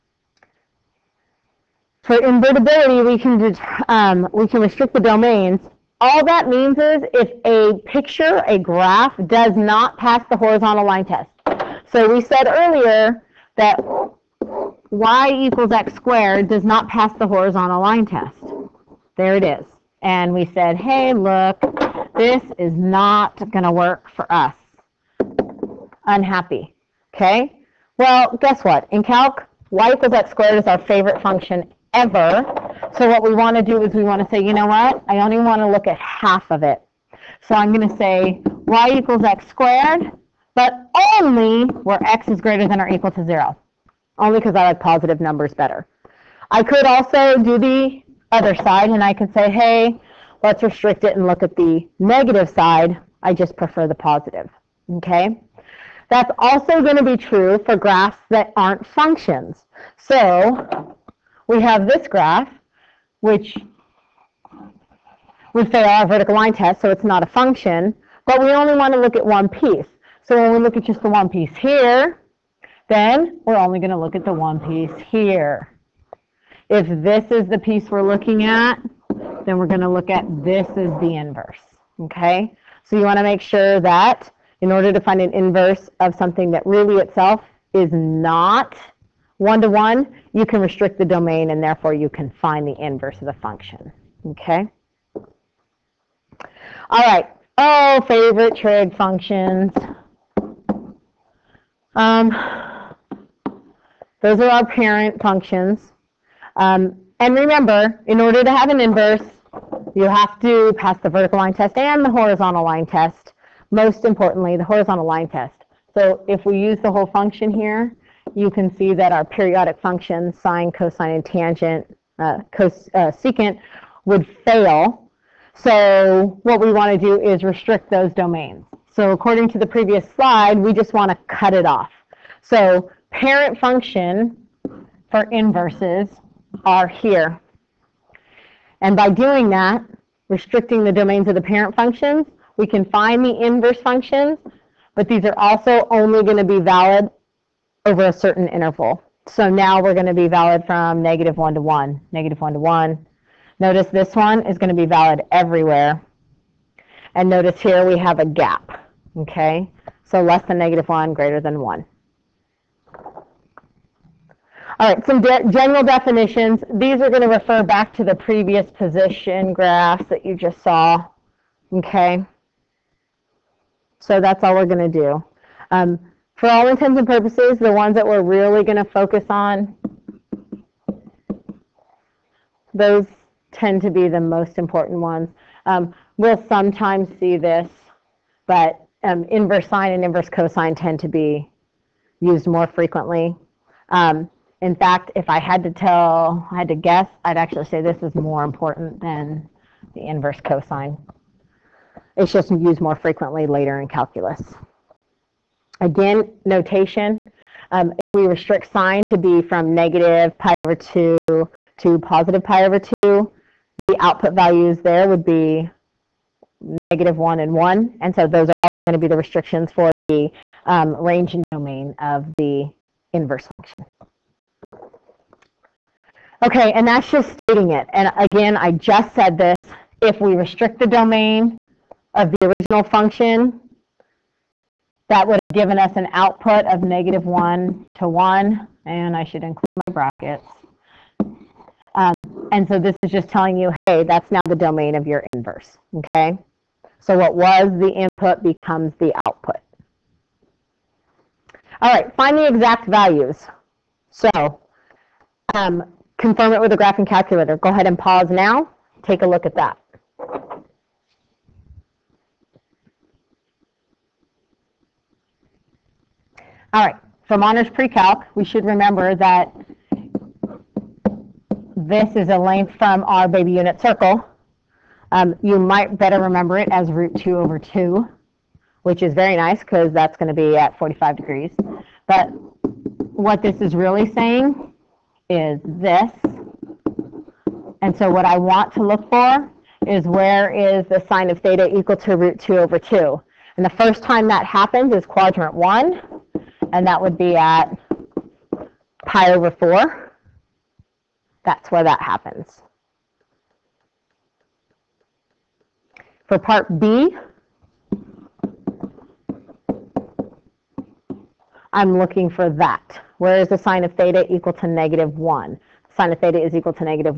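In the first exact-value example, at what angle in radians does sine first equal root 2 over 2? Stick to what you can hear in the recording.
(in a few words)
pi over 4.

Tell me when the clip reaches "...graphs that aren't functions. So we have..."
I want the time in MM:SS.
00:57.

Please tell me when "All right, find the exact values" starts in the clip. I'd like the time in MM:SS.
04:11.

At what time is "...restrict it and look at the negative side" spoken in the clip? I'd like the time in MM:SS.
00:50.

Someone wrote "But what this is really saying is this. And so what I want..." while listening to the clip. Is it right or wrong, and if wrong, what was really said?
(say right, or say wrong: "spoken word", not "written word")
right.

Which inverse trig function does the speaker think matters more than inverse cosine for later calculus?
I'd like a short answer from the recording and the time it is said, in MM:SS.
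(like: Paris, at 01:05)
inverse sine, at 03:09.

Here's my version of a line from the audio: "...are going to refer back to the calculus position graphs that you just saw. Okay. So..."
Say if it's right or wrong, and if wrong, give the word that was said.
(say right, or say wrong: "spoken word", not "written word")
wrong: "previous", not "calculus".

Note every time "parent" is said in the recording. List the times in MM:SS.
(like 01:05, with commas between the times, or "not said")
01:44, 02:13, 02:21.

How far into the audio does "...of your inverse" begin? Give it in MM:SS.
04:04.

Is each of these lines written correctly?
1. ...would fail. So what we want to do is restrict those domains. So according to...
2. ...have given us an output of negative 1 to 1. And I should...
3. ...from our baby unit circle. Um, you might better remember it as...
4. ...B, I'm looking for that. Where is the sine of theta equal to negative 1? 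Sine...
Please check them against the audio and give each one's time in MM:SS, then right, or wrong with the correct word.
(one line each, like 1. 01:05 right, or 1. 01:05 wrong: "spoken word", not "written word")
1. 02:04 right
2. 03:55 right
3. 04:32 right
4. 05:06 right.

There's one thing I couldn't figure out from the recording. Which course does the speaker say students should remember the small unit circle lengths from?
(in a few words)
Honors Pre-Calc.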